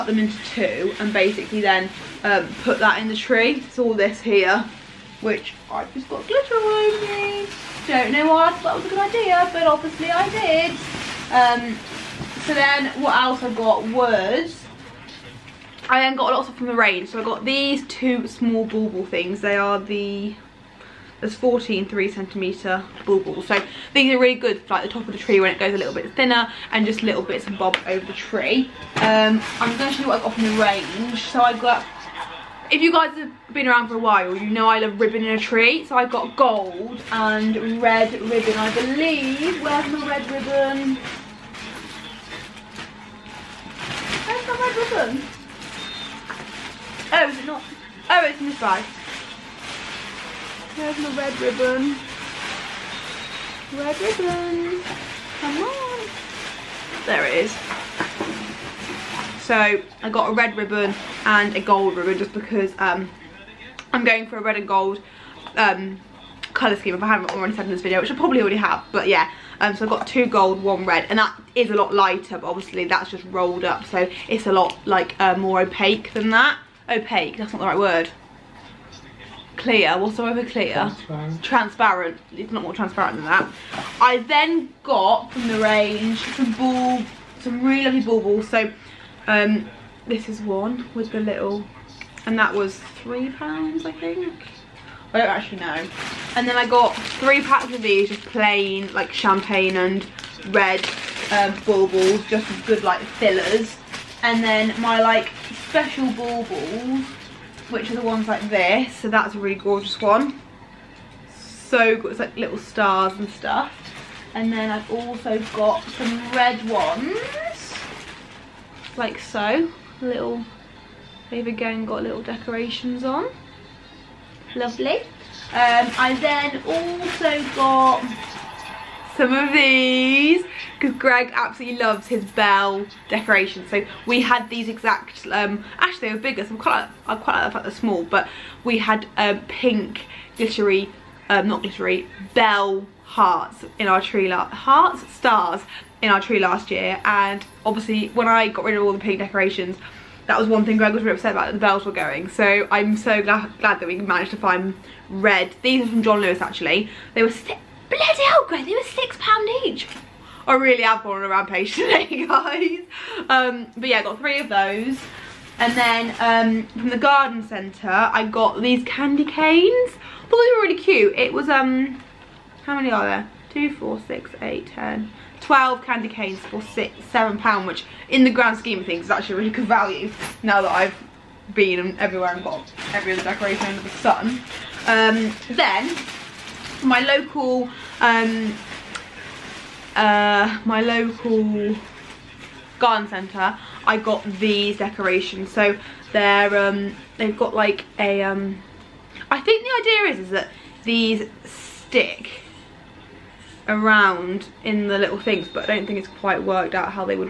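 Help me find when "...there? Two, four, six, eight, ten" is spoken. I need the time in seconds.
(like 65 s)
173 s.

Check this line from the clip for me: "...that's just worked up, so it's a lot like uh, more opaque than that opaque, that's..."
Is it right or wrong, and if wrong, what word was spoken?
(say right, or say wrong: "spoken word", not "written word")
wrong: "rolled", not "worked".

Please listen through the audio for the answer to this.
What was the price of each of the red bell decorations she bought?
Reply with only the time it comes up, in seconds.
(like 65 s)
158 s.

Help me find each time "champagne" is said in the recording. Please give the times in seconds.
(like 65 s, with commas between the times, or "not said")
99 s.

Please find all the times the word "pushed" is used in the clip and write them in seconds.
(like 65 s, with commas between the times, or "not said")
not said.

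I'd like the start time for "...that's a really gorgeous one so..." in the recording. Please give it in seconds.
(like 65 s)
109 s.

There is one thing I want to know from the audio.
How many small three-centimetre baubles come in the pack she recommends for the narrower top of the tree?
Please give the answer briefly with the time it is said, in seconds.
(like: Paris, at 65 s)
14, at 21 s.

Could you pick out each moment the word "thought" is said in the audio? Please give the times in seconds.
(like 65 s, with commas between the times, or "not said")
8 s, 170 s.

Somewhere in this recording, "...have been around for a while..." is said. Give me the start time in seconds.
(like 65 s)
33 s.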